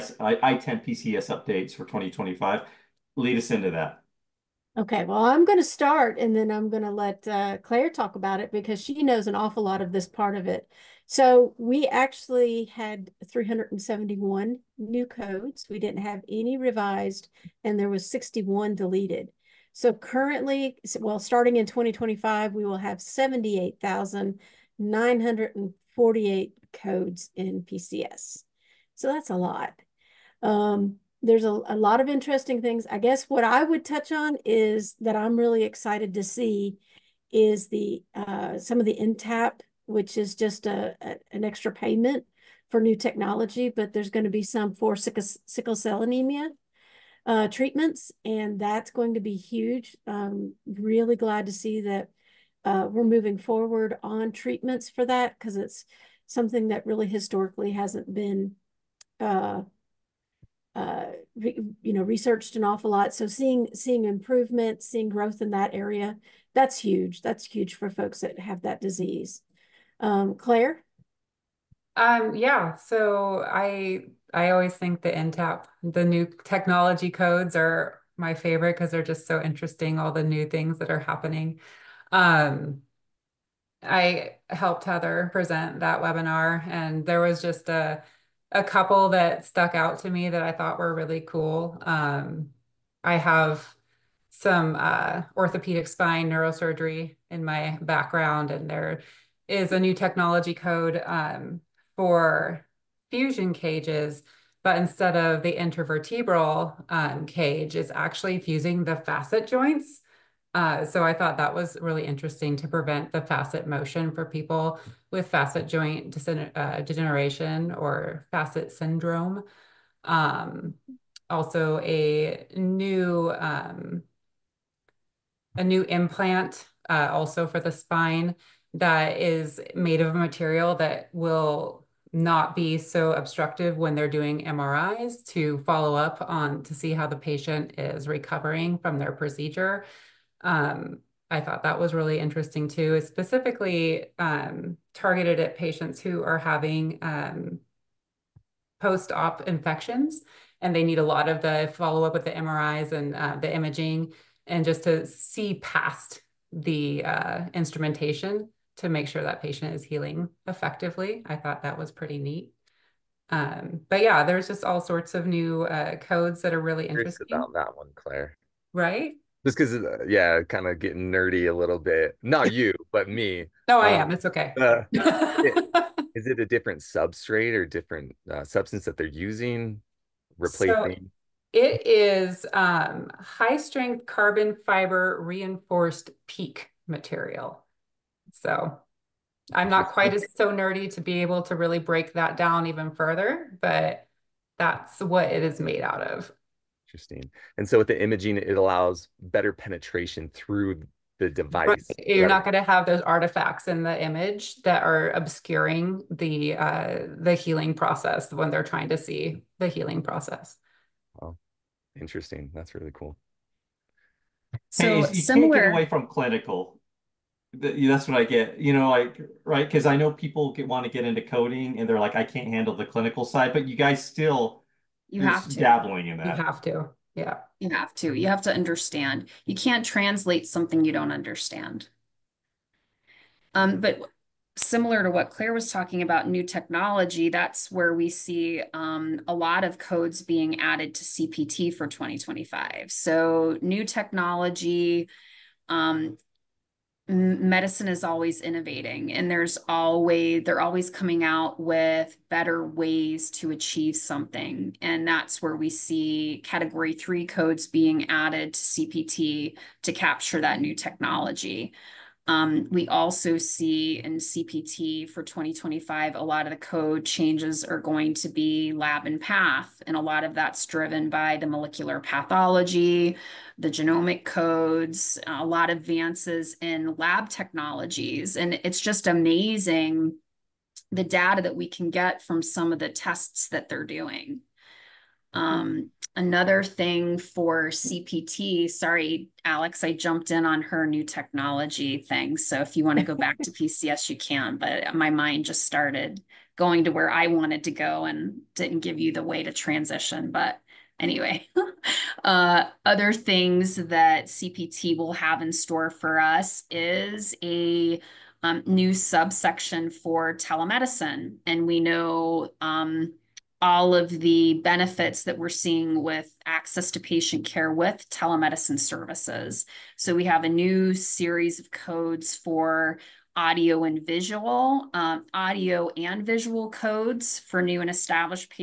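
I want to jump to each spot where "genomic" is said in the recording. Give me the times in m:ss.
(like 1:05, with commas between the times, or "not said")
4:33.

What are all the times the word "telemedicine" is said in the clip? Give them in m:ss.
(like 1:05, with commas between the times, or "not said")
5:10, 5:18.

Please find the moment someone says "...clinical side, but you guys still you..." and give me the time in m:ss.
3:42.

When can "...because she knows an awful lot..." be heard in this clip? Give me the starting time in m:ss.
0:08.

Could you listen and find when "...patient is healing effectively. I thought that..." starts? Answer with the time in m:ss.
2:39.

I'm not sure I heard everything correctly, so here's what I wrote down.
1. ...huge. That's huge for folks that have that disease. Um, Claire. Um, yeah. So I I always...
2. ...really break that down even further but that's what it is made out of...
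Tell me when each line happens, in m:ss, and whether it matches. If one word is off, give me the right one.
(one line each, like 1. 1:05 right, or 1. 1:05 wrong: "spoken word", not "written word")
1. 1:06 right
2. 3:11 right.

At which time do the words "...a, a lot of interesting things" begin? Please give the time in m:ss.
0:31.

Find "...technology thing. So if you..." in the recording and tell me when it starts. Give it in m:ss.
4:51.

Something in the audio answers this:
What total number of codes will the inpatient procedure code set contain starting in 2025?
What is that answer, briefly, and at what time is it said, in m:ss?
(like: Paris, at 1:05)
78,948, at 0:23.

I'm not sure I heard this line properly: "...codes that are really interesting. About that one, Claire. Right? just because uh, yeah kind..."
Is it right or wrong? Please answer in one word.
right.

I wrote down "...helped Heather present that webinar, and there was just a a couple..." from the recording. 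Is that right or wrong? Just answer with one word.
right.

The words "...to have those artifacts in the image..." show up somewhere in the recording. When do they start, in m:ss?
3:22.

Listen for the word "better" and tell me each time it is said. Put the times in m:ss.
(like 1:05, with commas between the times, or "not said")
3:19, 4:12.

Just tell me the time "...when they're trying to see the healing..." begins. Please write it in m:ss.
3:28.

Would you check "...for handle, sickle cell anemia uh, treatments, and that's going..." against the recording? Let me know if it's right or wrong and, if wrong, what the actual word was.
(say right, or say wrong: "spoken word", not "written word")
wrong: "sickle", not "handle".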